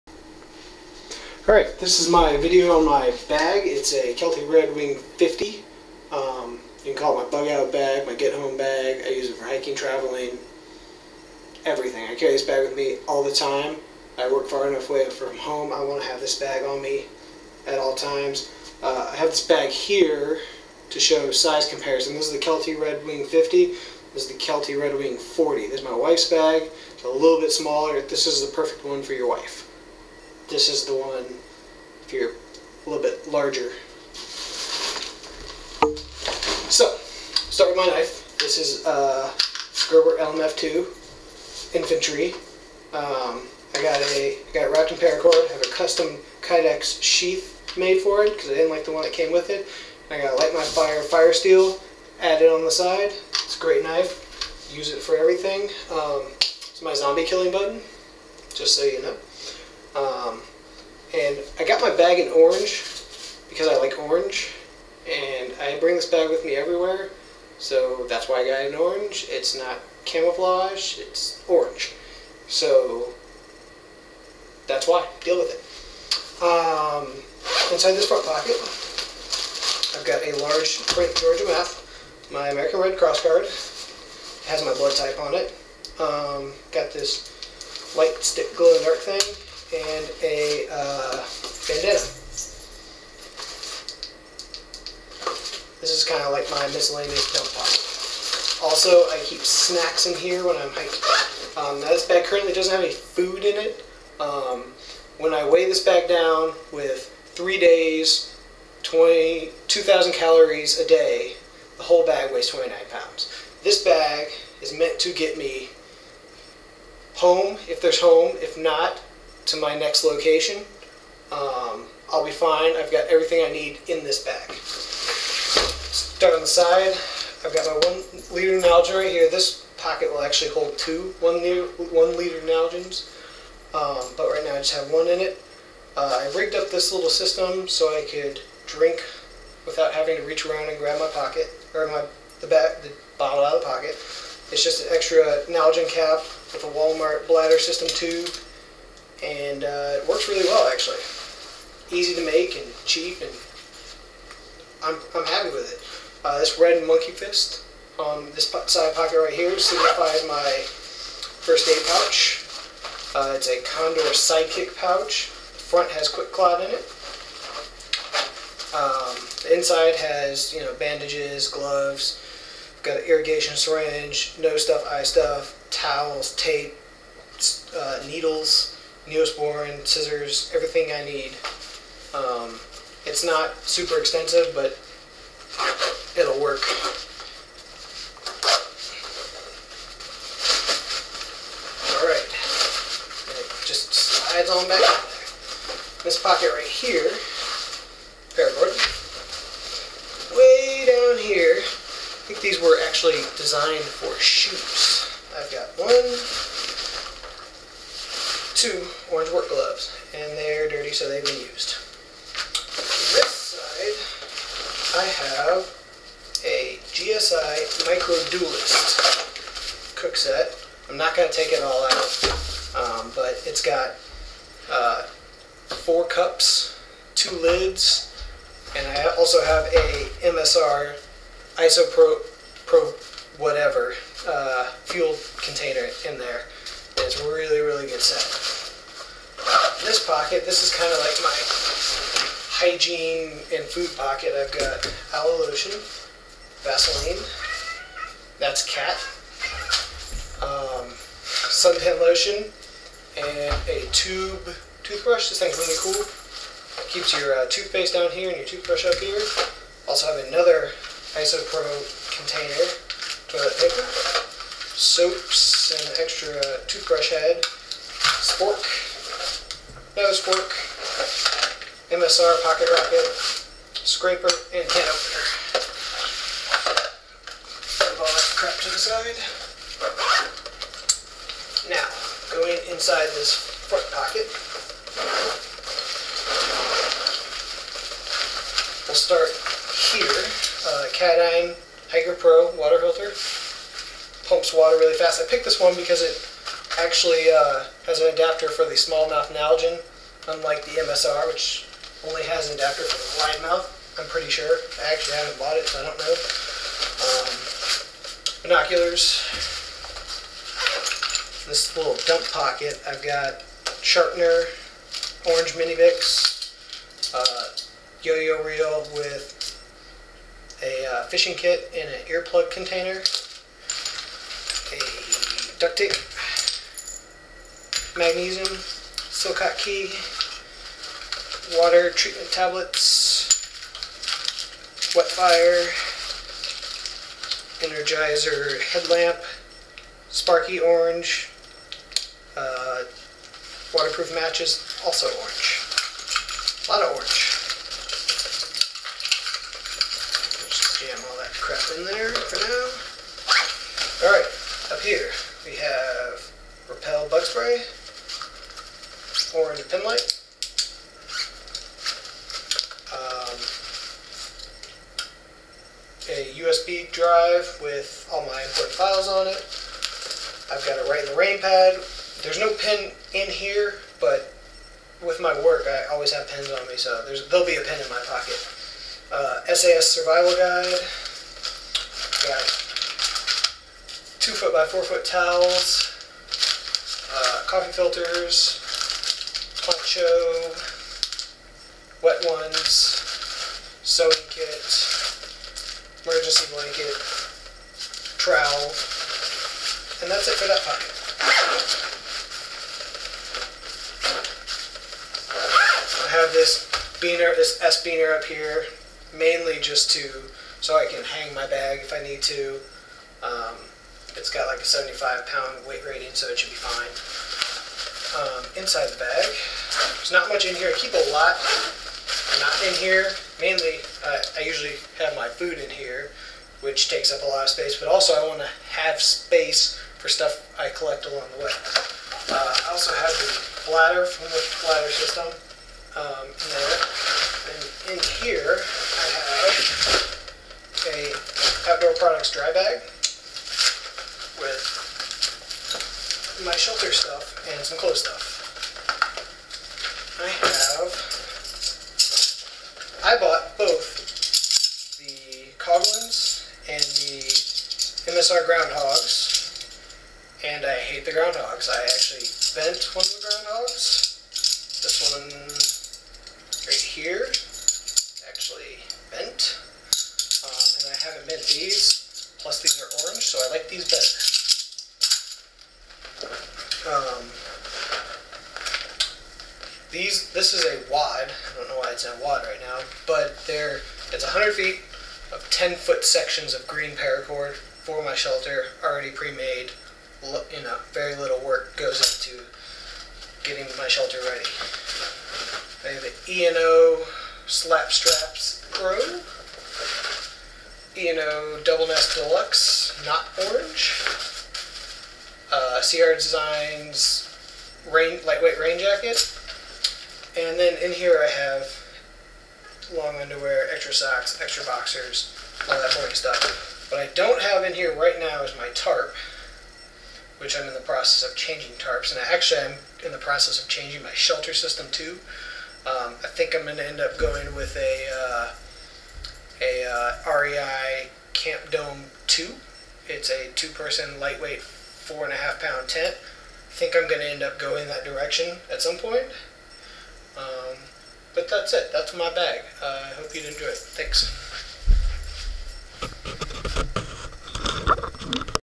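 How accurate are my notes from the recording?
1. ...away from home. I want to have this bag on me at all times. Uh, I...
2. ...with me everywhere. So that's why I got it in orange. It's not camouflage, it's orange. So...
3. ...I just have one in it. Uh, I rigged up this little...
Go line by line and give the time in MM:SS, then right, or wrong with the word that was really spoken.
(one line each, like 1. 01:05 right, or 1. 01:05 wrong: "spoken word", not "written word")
1. 00:14 right
2. 01:06 right
3. 02:14 right.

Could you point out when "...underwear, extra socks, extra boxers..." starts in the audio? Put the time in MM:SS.
08:33.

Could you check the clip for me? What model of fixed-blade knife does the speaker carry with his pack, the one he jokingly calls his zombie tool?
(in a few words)
Gerber LMF2 Infantry.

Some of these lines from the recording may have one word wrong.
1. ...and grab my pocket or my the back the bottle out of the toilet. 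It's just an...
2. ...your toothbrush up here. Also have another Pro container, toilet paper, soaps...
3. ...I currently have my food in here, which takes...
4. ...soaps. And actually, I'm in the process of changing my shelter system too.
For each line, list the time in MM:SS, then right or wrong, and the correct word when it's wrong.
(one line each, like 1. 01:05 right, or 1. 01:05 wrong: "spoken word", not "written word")
1. 02:20 wrong: "pocket", not "toilet"
2. 04:18 wrong: "IsoPro", not "Pro"
3. 07:04 wrong: "usually", not "currently"
4. 08:41 wrong: "tarps", not "soaps".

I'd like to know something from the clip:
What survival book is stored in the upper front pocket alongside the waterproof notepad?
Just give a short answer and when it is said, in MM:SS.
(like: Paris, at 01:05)
SAS Survival Guide, at 06:19.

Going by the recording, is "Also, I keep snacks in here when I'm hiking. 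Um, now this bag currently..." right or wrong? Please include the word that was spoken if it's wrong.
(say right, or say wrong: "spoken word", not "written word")
right.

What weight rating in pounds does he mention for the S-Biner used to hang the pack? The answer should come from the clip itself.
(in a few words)
75.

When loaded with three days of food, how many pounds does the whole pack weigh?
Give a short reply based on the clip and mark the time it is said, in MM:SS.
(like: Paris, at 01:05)
29, at 01:52.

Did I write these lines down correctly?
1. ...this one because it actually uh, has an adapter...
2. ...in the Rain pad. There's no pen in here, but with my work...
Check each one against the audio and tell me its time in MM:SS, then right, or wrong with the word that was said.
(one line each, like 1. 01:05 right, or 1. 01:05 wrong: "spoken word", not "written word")
1. 04:55 right
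2. 06:11 right.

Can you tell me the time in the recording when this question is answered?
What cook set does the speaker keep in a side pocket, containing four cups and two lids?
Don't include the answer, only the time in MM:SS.
03:36.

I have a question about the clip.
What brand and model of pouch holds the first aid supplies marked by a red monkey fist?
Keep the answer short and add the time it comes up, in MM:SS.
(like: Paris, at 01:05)
Condor Sidekick, at 02:43.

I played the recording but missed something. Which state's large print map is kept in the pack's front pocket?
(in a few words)
Georgia.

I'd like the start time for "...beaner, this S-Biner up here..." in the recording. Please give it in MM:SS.
06:47.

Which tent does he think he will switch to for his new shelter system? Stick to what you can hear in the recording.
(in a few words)
REI Camp Dome 2.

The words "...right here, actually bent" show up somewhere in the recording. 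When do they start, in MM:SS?
07:46.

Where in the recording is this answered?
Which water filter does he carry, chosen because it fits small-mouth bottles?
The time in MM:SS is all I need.
04:50.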